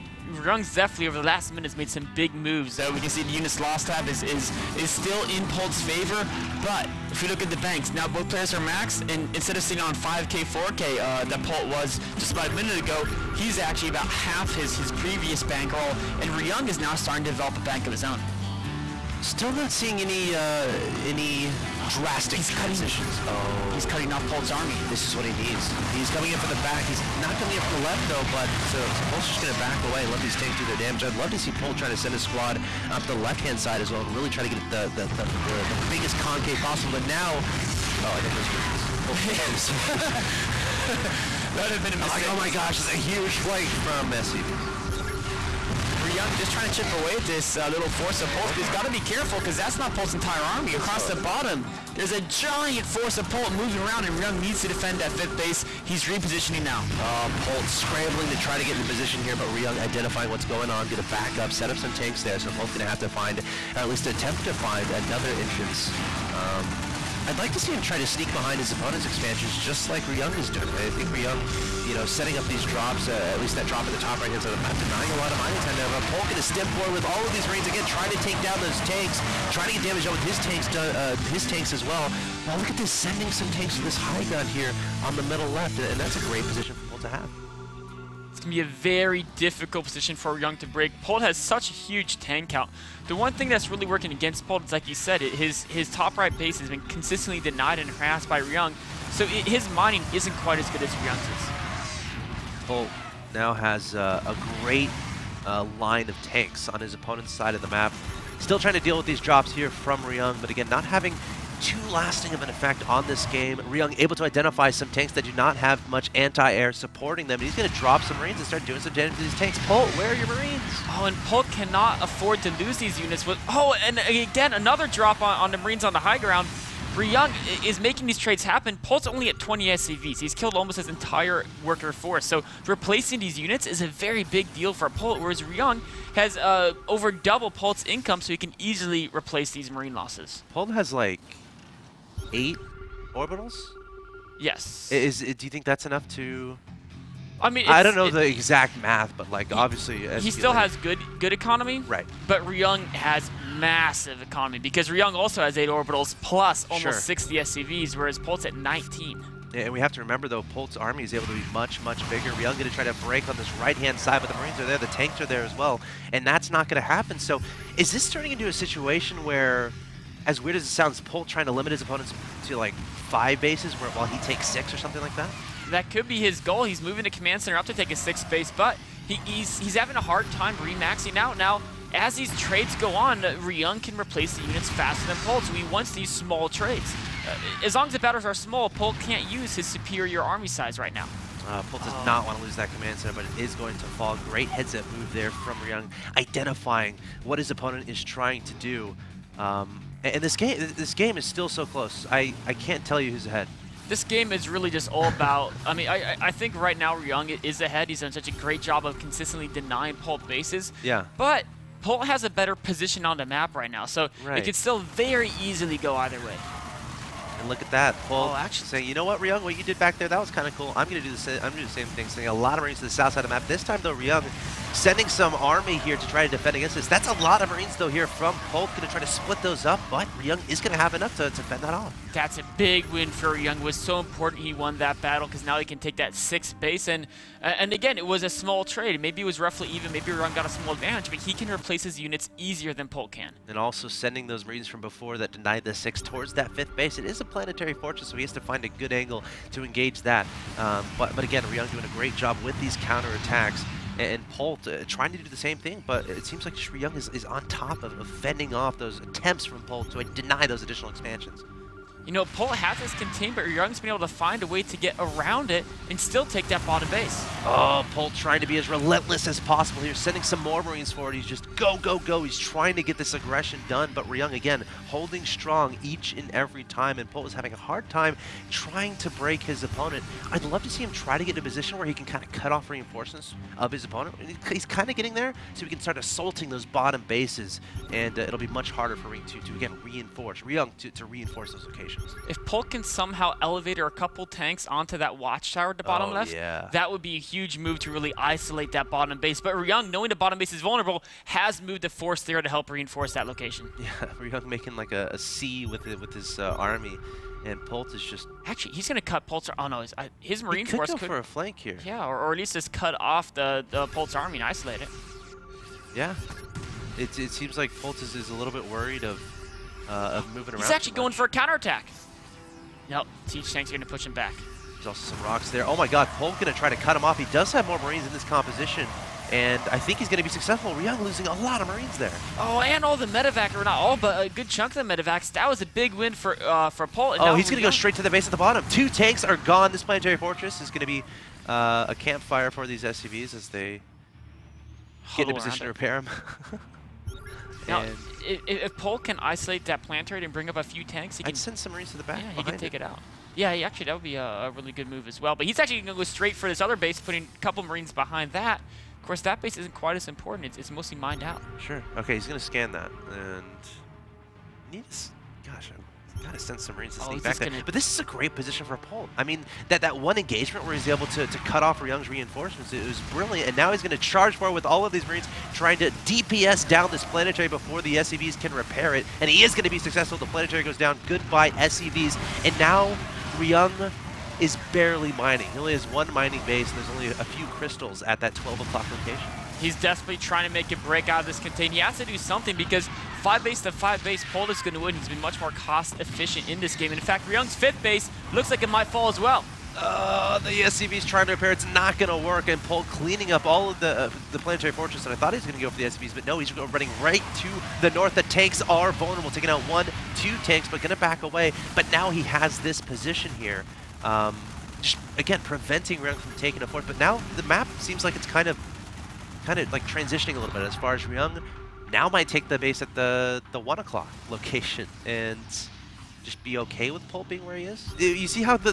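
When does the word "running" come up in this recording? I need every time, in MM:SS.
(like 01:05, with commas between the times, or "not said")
06:46.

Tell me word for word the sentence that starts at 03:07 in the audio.
Uh, as long as the batters are small, Polt can't use his superior army size right now.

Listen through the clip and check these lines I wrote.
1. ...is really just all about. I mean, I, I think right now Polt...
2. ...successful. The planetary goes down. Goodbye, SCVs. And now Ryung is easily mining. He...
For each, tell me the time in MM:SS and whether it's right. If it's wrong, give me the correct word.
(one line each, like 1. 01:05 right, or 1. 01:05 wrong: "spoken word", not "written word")
1. 03:24 wrong: "Ryung", not "Polt"
2. 06:19 wrong: "barely", not "easily".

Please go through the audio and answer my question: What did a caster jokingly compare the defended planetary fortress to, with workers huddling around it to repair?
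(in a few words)
a campfire.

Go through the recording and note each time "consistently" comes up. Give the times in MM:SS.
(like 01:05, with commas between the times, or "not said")
01:36, 03:28.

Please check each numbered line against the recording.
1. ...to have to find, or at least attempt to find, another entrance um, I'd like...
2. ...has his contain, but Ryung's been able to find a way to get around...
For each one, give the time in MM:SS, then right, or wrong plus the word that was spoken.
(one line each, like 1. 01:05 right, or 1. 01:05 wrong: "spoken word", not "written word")
1. 01:02 right
2. 04:22 right.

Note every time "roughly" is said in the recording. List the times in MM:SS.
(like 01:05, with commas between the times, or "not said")
03:59.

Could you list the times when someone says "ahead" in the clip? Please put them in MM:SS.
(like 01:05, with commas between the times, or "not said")
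03:23, 03:27.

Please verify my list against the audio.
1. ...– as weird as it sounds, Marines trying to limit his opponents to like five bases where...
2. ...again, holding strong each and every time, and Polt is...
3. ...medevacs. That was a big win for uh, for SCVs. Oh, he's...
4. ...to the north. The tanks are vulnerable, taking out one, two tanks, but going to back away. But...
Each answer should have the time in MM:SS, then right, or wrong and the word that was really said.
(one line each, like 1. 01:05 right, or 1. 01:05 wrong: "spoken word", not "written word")
1. 02:49 wrong: "Polt", not "Marines"
2. 04:34 right
3. 05:34 wrong: "Polt", not "SCVs"
4. 06:47 right.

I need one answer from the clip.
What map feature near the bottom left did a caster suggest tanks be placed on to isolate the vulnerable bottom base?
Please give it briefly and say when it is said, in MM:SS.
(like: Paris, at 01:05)
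watchtower, at 04:55.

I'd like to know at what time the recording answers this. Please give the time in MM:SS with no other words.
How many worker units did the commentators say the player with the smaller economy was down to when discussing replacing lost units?
02:09.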